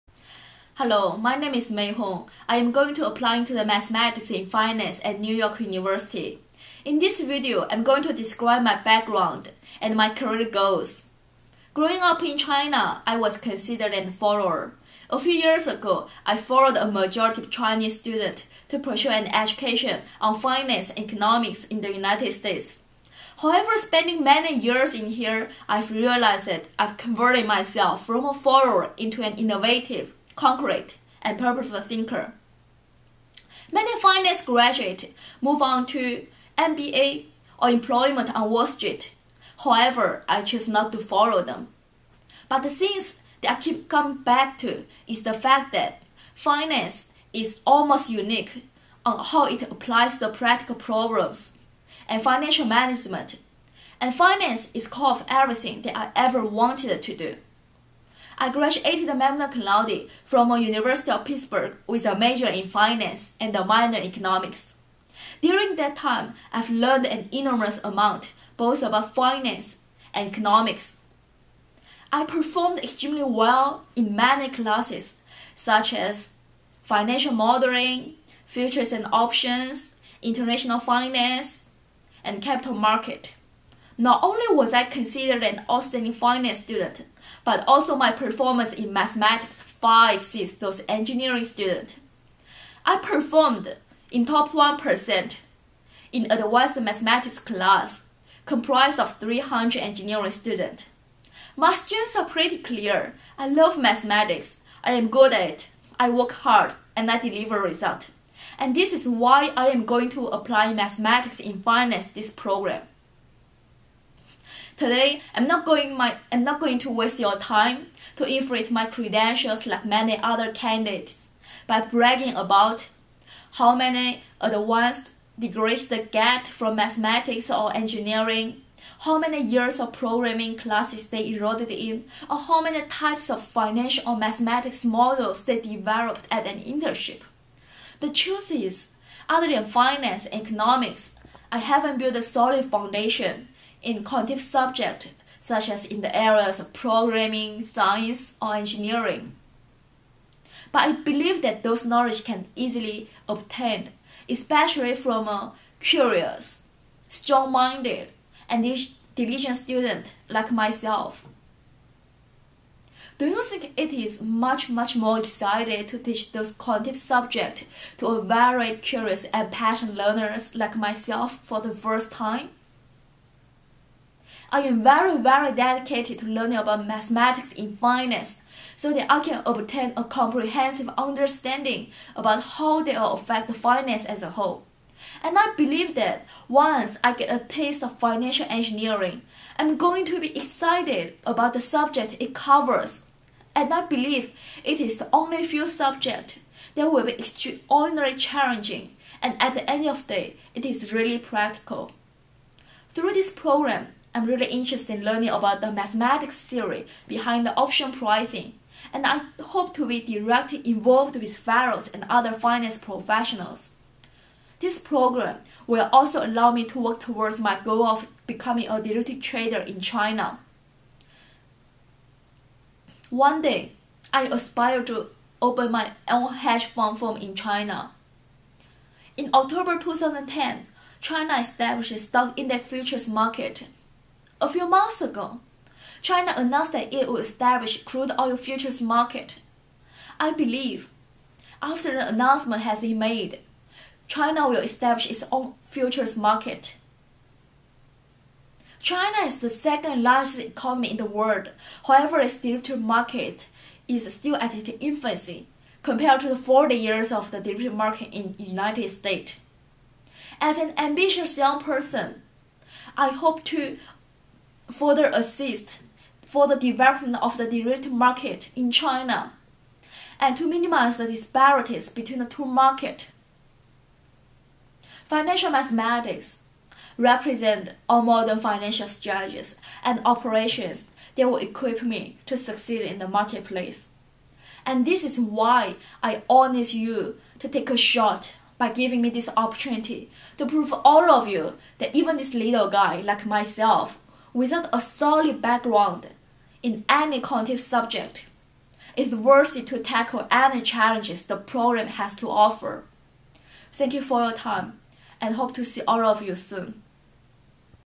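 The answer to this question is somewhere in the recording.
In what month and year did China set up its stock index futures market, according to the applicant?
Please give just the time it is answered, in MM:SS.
03:49.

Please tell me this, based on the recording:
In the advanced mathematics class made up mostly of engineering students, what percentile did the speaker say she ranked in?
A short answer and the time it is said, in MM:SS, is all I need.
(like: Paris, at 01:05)
top 1%, at 01:34.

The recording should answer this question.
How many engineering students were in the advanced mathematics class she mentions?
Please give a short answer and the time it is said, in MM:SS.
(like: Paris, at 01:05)
300, at 01:39.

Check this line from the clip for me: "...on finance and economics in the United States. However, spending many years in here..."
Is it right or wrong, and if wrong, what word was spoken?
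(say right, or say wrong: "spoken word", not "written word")
right.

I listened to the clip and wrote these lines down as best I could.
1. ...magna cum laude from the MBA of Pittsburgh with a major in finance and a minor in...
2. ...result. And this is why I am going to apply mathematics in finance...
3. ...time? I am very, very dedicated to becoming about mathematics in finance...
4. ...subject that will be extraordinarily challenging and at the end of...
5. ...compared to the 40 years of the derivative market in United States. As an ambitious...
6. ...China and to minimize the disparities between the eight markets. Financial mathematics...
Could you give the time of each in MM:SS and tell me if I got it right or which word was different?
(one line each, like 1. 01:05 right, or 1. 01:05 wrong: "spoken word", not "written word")
1. 00:59 wrong: "University", not "MBA"
2. 01:47 right
3. 02:52 wrong: "learning", not "becoming"
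4. 03:15 right
5. 04:15 right
6. 04:28 wrong: "two", not "eight".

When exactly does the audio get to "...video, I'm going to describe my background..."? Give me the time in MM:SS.
00:07.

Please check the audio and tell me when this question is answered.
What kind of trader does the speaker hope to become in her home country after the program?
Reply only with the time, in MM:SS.
03:38.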